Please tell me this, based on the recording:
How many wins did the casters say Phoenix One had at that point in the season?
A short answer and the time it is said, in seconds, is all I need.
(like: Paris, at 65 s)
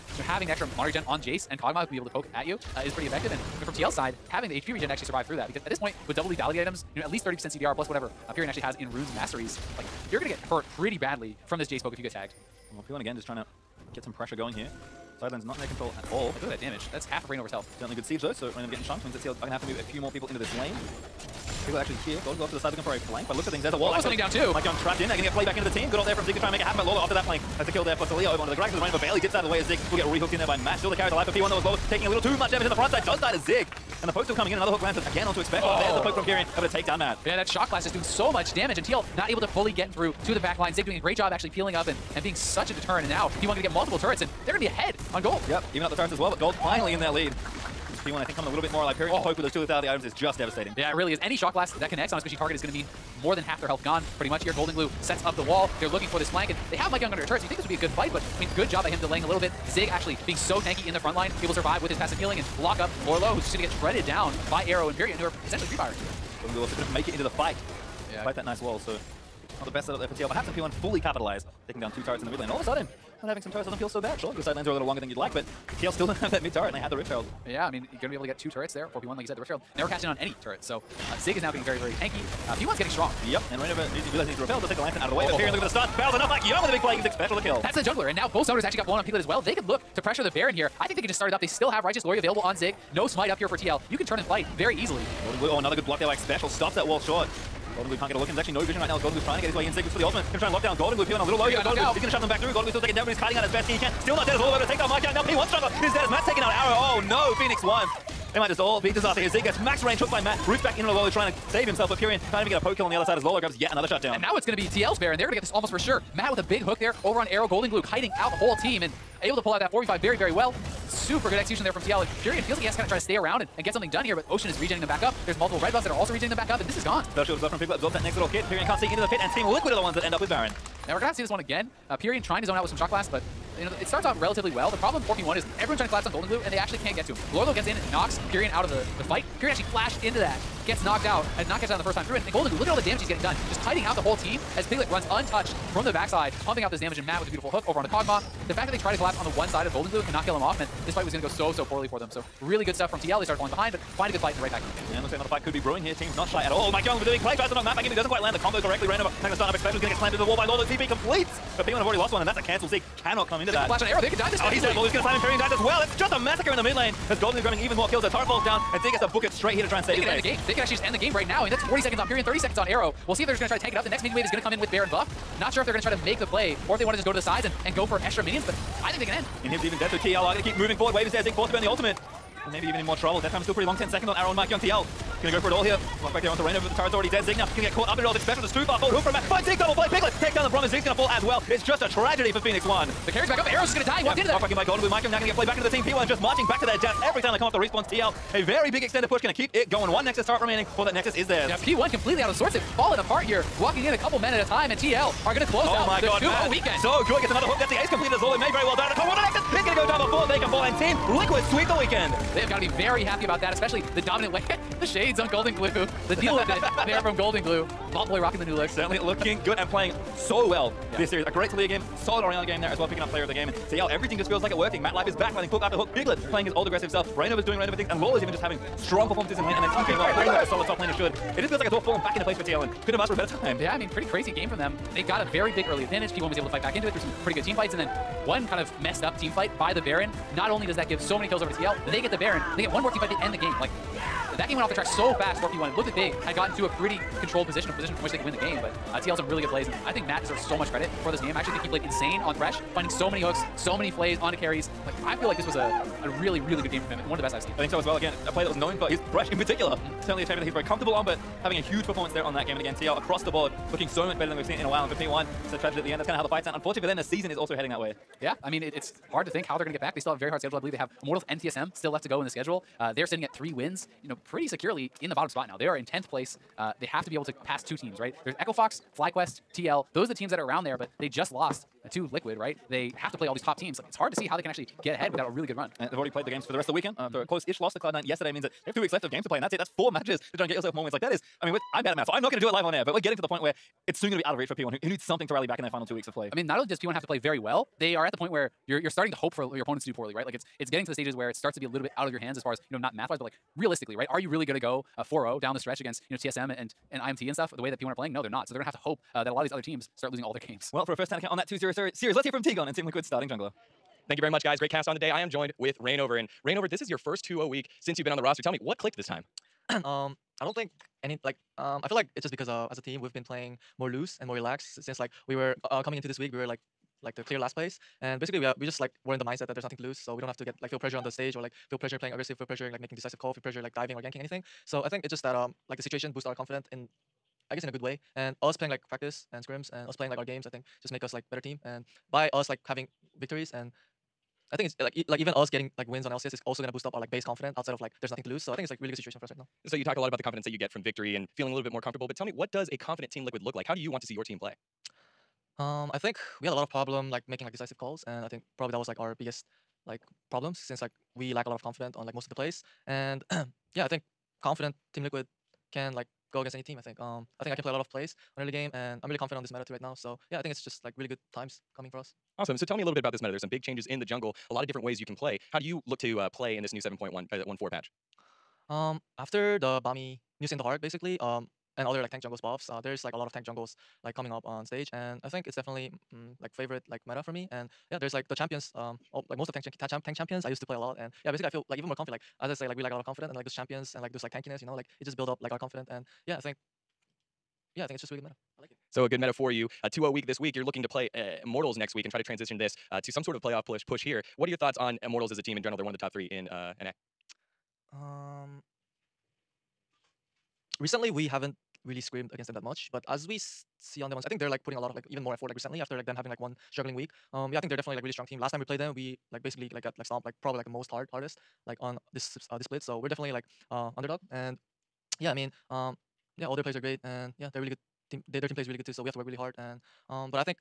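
3, at 273 s.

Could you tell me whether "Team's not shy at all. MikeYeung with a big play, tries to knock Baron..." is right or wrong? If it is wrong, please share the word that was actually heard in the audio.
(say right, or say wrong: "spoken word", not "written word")
wrong: "Matt", not "Baron".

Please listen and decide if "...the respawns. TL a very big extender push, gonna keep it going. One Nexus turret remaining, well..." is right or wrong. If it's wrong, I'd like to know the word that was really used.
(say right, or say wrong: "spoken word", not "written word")
right.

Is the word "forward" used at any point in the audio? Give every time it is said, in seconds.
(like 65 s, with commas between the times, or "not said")
180 s, 188 s.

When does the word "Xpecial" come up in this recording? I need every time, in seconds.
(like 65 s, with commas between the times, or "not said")
96 s, 188 s.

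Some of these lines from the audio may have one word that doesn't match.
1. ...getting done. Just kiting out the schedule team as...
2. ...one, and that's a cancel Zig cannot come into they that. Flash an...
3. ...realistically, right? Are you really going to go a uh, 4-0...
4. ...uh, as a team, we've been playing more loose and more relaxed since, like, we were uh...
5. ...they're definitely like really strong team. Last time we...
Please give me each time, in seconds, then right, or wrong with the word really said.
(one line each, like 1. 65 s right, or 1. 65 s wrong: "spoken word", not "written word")
1. 143 s wrong: "whole", not "schedule"
2. 162 s right
3. 303 s right
4. 322 s right
5. 417 s right.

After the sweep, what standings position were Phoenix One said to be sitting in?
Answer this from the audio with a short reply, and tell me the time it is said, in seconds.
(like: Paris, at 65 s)
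10th place, at 275 s.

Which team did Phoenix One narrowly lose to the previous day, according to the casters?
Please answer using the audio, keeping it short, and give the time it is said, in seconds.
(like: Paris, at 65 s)
Cloud9, at 287 s.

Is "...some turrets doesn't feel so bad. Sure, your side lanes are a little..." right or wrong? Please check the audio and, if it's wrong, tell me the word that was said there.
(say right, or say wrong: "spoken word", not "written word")
right.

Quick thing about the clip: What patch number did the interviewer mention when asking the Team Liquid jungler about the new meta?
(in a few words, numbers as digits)
7.14.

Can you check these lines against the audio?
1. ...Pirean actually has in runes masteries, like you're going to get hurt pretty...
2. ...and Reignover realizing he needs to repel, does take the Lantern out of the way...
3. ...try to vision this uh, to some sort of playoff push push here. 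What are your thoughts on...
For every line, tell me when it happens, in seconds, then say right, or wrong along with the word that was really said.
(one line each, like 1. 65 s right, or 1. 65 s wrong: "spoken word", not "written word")
1. 8 s right
2. 83 s right
3. 402 s wrong: "transition", not "vision".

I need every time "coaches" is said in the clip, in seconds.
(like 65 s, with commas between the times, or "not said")
not said.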